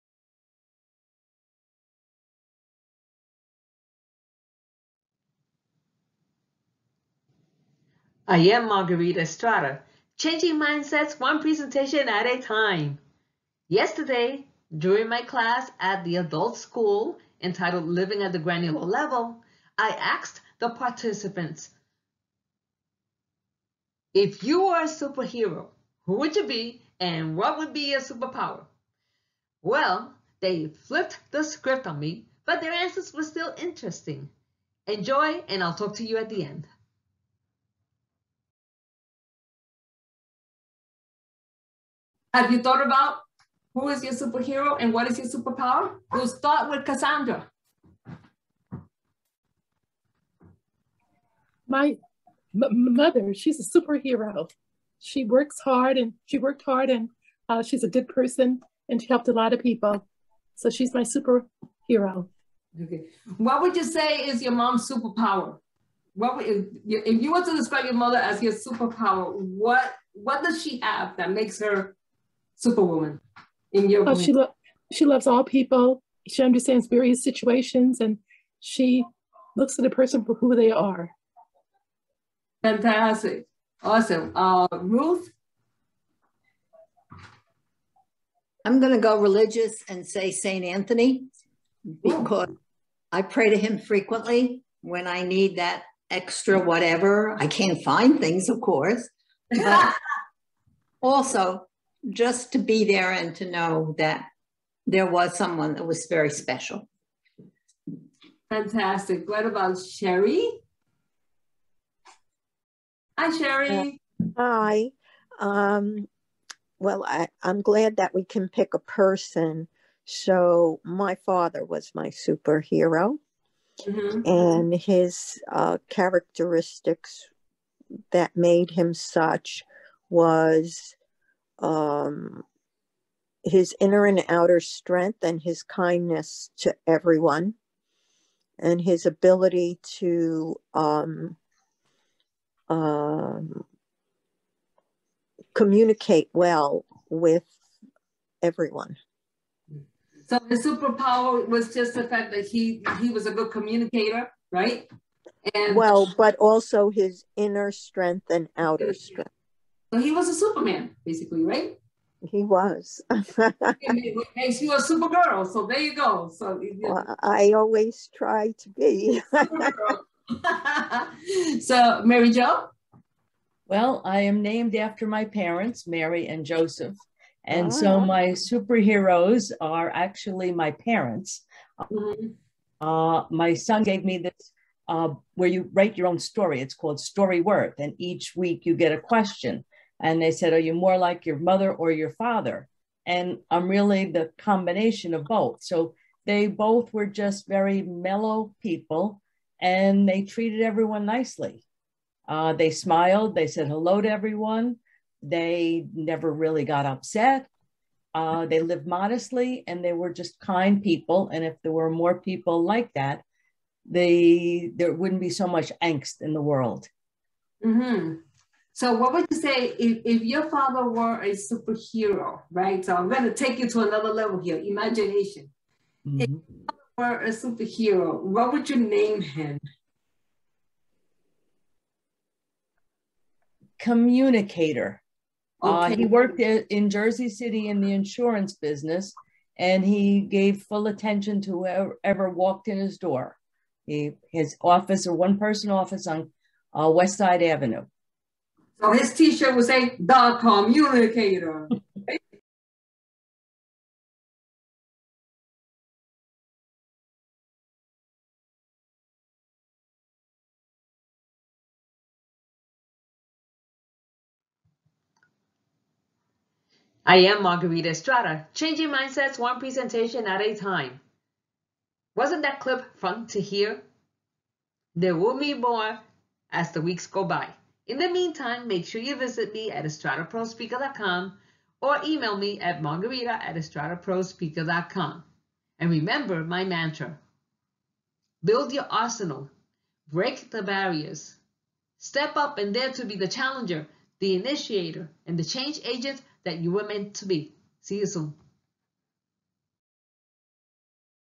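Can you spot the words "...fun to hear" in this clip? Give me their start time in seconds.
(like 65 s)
272 s.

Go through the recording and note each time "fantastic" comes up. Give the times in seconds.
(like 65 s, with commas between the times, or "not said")
82 s, 108 s.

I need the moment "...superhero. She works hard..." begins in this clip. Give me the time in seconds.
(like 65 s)
53 s.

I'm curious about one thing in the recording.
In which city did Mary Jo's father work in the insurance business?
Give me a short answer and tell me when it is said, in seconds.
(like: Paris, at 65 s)
Jersey City, at 236 s.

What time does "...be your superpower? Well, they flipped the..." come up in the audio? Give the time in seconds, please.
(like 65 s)
27 s.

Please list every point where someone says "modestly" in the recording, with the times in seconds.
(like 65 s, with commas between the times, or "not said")
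208 s.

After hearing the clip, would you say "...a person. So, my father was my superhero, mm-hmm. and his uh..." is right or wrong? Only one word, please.
right.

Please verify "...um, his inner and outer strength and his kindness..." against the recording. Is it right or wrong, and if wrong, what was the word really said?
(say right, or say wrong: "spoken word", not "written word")
right.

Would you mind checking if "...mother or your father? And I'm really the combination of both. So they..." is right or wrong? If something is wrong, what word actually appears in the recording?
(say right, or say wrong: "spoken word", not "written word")
right.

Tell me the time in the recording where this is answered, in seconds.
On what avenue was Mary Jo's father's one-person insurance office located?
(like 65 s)
246 s.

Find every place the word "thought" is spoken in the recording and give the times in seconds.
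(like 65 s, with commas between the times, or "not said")
42 s.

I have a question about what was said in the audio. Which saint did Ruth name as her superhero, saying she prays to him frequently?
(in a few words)
Saint Anthony.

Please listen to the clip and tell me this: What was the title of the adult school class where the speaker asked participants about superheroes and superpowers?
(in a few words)
Living at the Granular Level.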